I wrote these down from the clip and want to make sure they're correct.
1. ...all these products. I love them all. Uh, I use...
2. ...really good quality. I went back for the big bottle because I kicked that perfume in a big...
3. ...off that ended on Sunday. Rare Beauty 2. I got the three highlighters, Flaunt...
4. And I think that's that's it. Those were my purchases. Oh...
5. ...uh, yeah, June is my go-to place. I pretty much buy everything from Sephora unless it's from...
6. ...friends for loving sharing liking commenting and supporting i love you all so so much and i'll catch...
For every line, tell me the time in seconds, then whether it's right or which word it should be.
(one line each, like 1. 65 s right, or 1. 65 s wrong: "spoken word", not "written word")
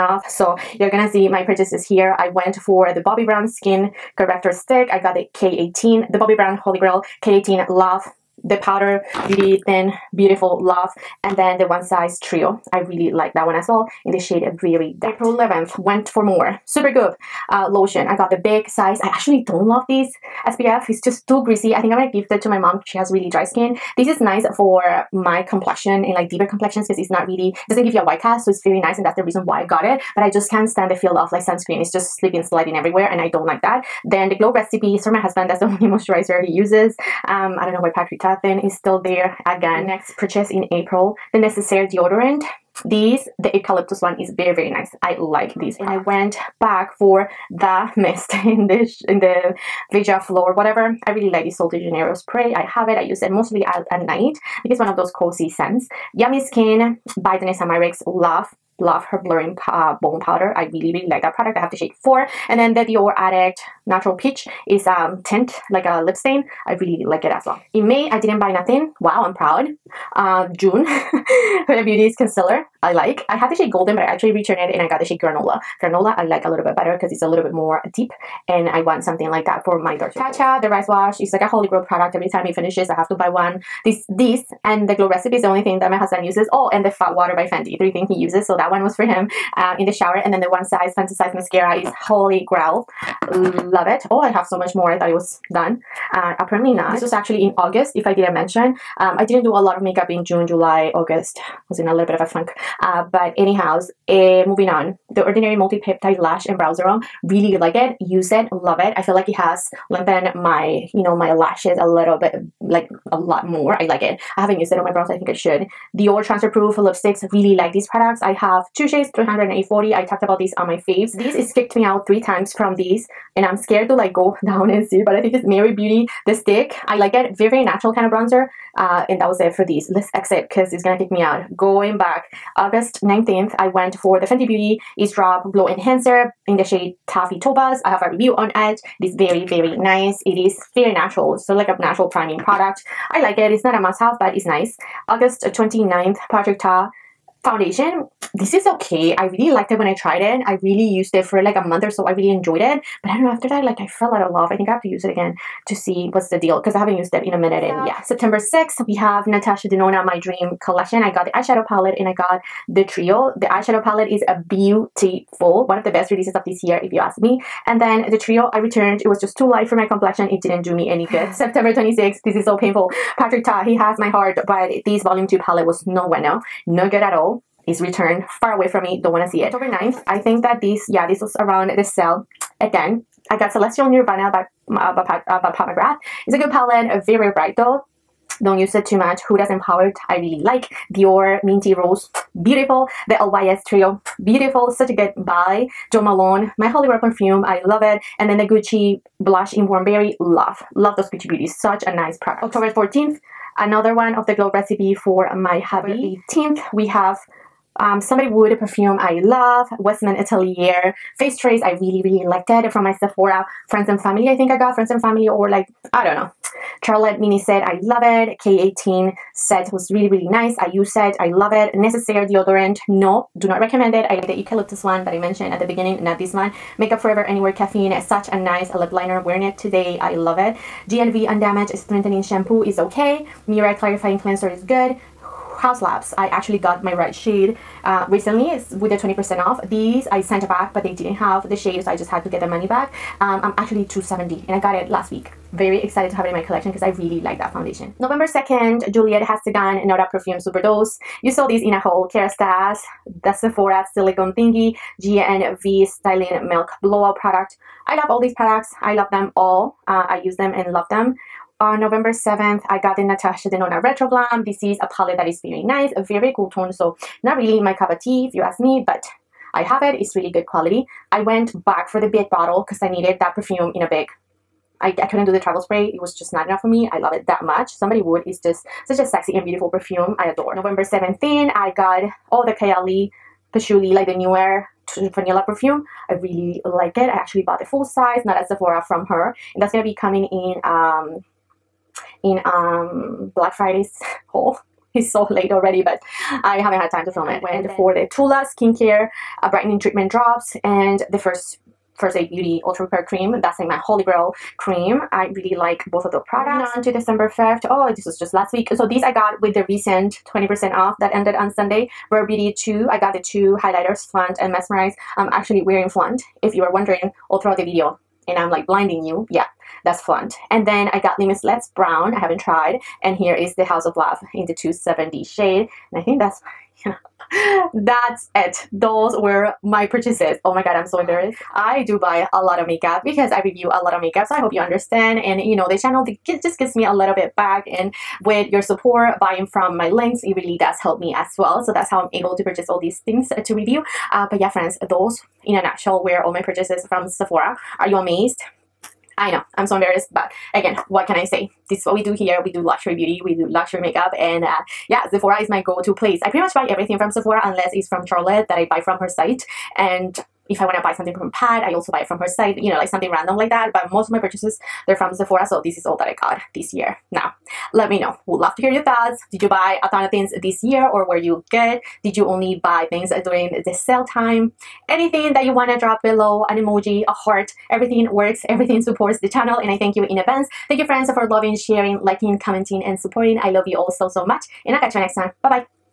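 1. 258 s right
2. 270 s wrong: "needed", not "kicked"
3. 310 s wrong: "two", not "three"
4. 325 s right
5. 354 s wrong: "Sephora", not "June"
6. 380 s right.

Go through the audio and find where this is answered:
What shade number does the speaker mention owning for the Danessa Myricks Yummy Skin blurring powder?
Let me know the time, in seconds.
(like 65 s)
61 s.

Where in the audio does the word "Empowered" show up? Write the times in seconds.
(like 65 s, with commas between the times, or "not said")
189 s.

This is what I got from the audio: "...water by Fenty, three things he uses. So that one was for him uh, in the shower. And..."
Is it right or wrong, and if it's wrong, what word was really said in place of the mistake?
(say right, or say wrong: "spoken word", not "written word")
right.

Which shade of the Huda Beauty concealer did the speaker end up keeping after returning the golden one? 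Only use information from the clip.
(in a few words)
Granola.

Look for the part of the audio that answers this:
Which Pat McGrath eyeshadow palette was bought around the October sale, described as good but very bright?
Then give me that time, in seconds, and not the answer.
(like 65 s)
183 s.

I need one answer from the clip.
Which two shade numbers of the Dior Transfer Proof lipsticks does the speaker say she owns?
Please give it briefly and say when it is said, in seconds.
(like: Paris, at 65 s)
300 and 840, at 119 s.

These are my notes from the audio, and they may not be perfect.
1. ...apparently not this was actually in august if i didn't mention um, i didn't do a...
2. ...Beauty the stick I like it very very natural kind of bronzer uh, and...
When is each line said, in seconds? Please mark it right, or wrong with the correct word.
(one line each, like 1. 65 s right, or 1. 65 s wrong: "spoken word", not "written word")
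1. 96 s right
2. 125 s right.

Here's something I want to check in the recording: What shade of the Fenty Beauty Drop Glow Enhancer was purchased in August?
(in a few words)
Taffy Topaz.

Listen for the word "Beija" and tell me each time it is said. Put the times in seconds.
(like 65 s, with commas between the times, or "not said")
49 s.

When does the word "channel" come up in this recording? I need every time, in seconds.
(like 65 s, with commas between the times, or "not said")
335 s, 379 s.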